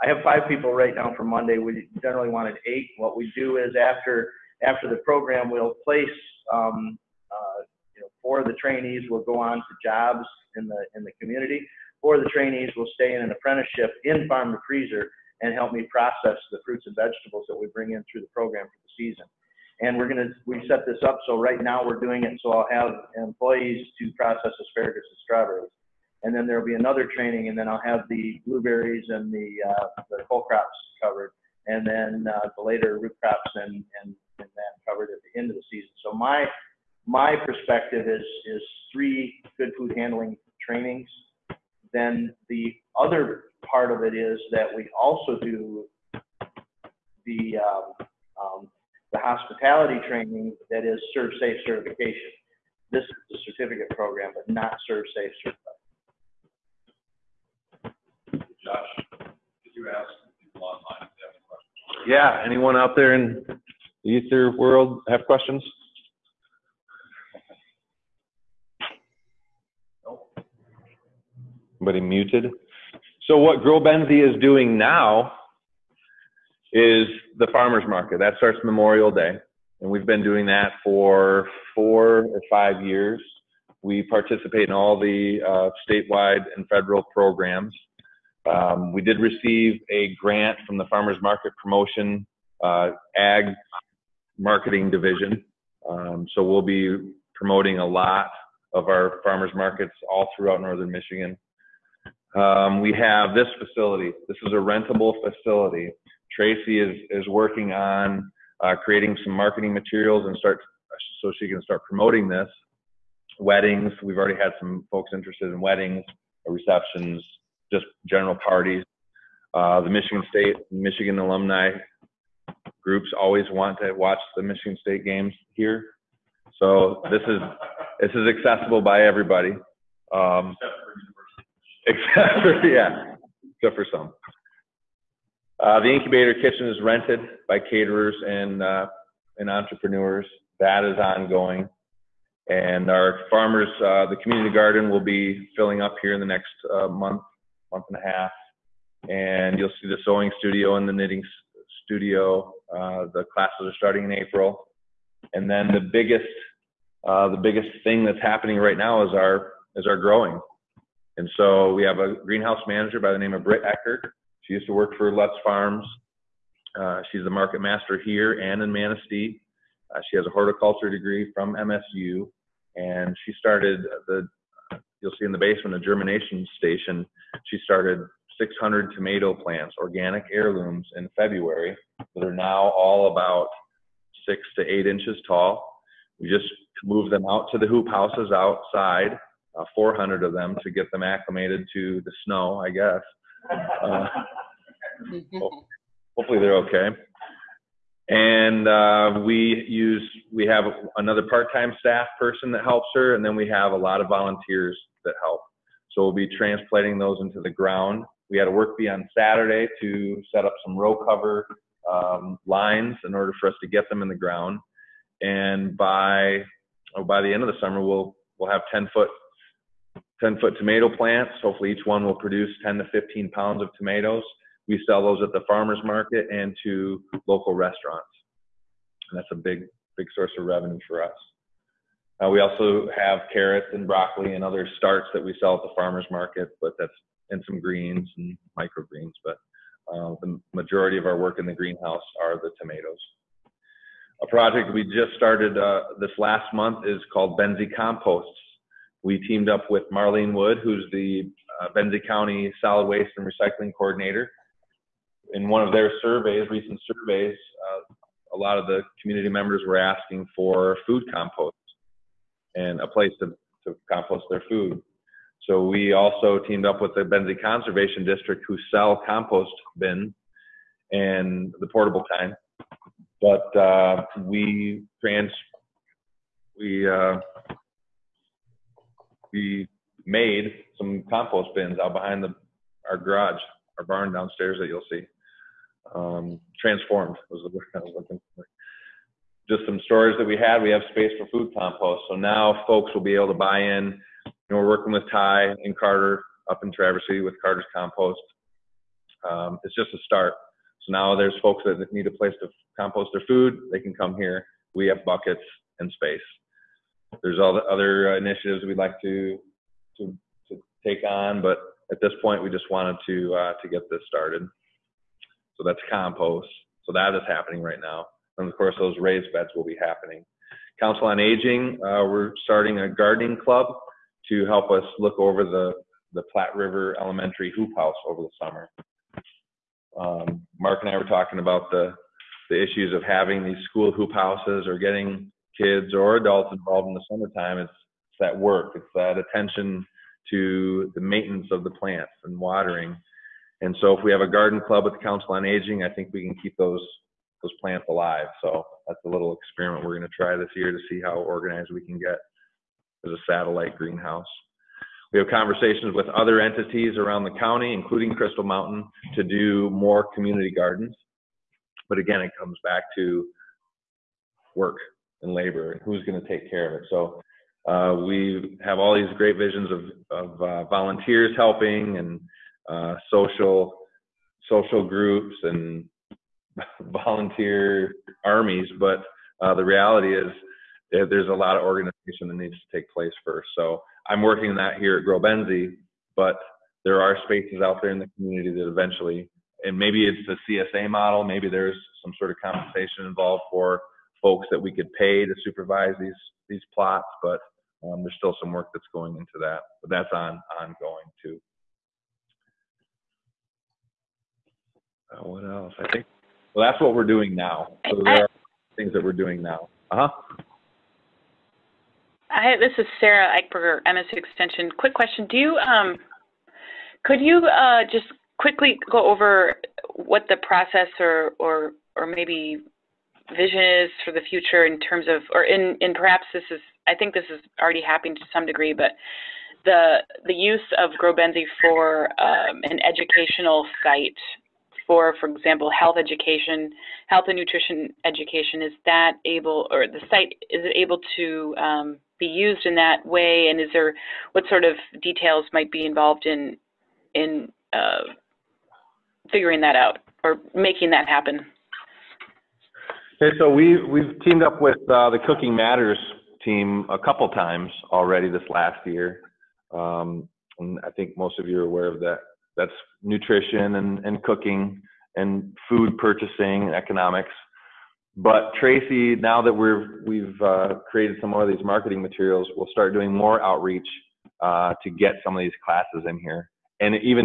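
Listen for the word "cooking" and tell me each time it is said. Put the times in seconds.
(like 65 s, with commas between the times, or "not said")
455 s, 464 s.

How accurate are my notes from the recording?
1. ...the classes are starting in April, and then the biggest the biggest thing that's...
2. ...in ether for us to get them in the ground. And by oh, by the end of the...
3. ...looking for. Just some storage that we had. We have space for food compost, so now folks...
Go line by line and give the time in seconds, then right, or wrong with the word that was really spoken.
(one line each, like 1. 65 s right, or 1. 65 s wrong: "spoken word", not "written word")
1. 153 s right
2. 213 s wrong: "order", not "ether"
3. 287 s right.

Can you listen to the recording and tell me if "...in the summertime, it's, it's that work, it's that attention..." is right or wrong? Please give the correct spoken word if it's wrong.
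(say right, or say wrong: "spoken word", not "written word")
right.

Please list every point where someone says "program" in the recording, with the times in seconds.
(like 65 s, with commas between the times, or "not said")
5 s, 18 s, 53 s, 87 s.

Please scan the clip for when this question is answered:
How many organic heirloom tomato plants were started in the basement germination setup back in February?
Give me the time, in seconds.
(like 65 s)
178 s.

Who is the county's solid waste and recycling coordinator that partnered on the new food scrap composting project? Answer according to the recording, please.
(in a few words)
Marlene Wood.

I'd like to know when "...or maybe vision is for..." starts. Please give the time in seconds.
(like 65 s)
421 s.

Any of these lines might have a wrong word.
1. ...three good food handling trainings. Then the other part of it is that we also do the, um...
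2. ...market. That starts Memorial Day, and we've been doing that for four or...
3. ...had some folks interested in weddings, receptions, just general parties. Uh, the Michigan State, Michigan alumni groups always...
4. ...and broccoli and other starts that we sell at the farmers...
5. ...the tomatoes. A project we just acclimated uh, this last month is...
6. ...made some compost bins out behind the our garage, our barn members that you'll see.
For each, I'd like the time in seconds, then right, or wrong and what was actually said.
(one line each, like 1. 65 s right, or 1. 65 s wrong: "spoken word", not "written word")
1. 38 s right
2. 77 s right
3. 114 s right
4. 233 s right
5. 242 s wrong: "started", not "acclimated"
6. 280 s wrong: "downstairs", not "members".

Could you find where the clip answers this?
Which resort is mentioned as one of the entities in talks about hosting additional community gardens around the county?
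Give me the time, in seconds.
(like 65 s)
358 s.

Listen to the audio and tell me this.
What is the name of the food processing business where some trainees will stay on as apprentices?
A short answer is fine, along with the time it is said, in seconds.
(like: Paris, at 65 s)
Farm to Freezer, at 14 s.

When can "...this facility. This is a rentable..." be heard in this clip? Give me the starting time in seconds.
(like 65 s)
103 s.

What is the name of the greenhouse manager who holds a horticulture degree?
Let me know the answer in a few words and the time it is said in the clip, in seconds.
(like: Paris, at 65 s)
Britt Eckert, at 163 s.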